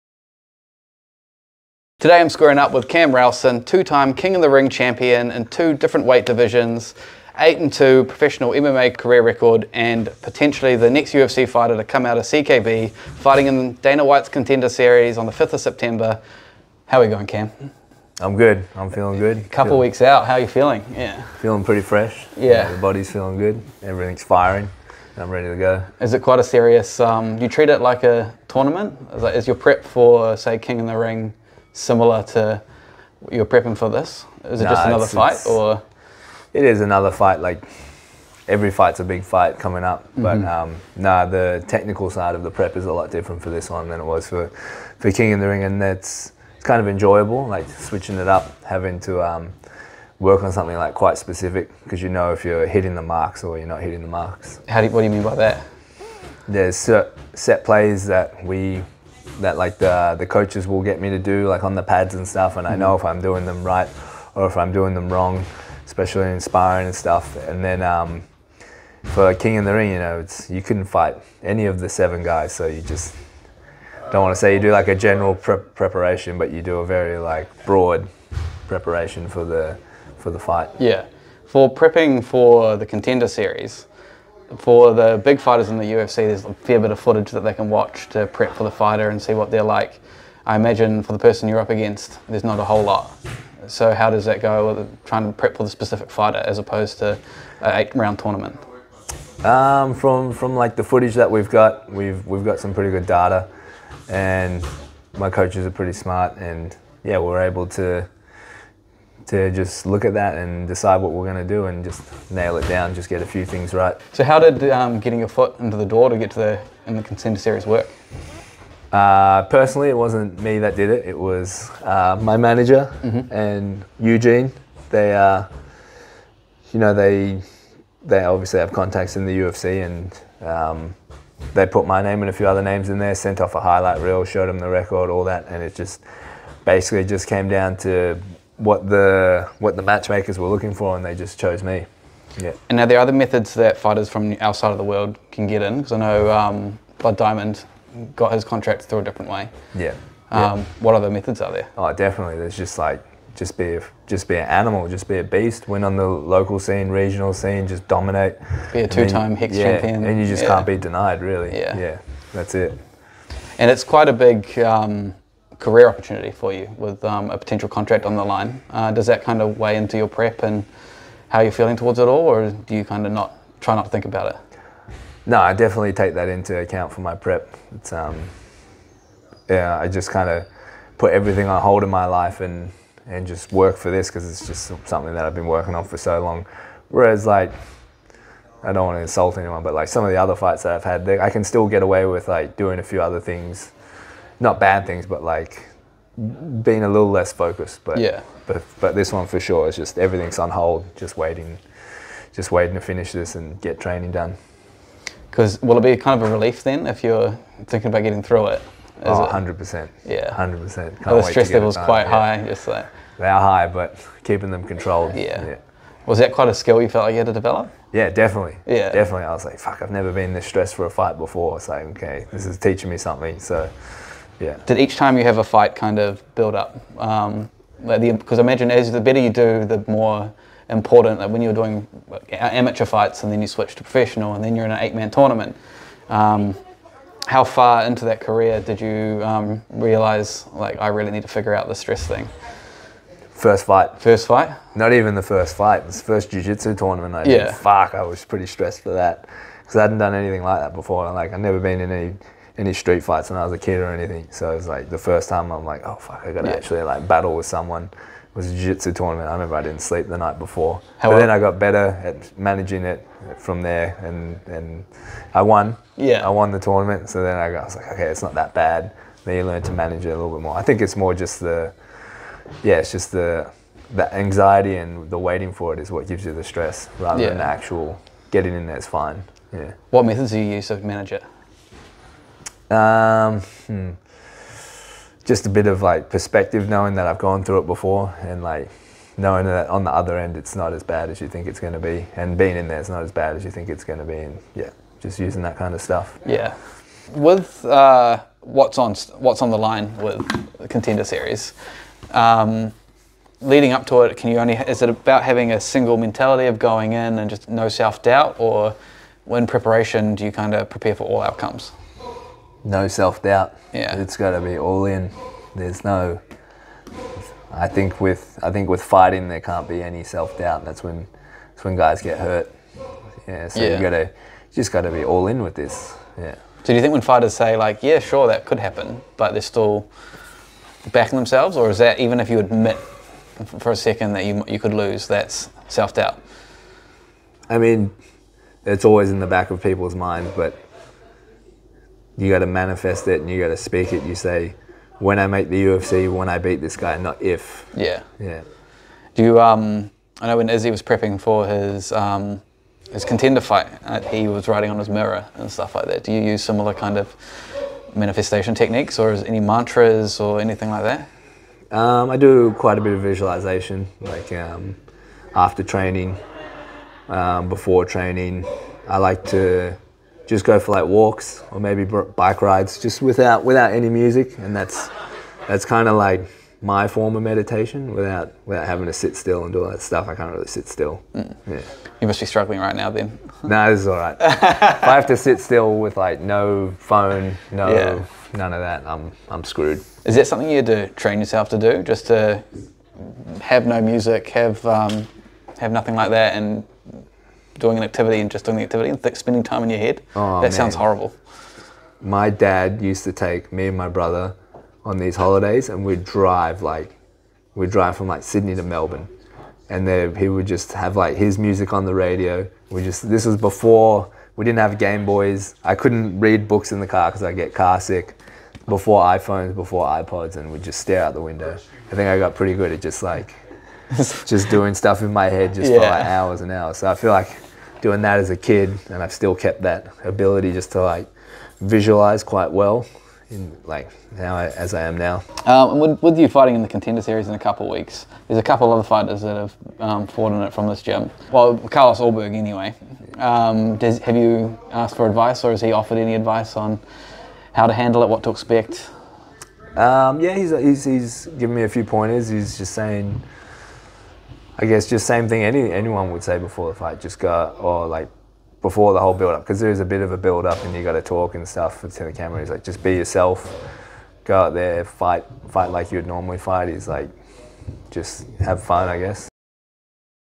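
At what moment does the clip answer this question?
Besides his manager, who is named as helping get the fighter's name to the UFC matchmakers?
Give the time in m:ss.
2:03.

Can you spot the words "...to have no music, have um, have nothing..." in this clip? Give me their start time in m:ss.
6:32.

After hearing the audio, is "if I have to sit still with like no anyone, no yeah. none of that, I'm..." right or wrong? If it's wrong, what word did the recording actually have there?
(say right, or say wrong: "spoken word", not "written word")
wrong: "phone", not "anyone".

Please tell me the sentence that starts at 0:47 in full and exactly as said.
Like switching it up, having to.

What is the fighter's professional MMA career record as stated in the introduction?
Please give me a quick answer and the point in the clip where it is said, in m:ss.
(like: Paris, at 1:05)
8 and 2, at 0:07.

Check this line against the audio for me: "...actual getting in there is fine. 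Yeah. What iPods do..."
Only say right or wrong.
wrong.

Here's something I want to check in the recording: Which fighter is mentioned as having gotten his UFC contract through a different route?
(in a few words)
Blood Diamond.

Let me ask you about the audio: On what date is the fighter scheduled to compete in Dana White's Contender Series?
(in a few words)
5th of September.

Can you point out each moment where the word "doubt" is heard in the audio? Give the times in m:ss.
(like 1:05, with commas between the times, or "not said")
5:08, 5:13, 5:20, 5:35.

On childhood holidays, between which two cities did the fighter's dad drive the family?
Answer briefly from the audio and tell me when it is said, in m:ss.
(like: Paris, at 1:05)
Sydney to Melbourne, at 6:48.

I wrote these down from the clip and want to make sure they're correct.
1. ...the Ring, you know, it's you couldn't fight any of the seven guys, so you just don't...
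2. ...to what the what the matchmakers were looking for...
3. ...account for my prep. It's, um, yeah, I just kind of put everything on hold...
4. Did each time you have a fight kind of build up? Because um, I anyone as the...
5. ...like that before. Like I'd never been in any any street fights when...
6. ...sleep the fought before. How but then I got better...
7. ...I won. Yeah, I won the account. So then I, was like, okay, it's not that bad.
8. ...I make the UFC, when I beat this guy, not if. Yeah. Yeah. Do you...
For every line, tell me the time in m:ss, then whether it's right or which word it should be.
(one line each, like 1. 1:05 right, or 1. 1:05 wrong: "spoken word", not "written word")
1. 1:09 right
2. 2:17 right
3. 2:56 right
4. 3:44 wrong: "imagine", not "anyone"
5. 4:10 right
6. 4:19 wrong: "night", not "fought"
7. 4:25 wrong: "tournament", not "account"
8. 5:45 right.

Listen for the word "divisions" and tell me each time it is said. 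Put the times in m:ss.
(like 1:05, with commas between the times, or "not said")
0:06.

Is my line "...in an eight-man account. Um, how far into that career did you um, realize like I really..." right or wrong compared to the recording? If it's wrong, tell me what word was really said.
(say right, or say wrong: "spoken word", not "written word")
wrong: "tournament", not "account".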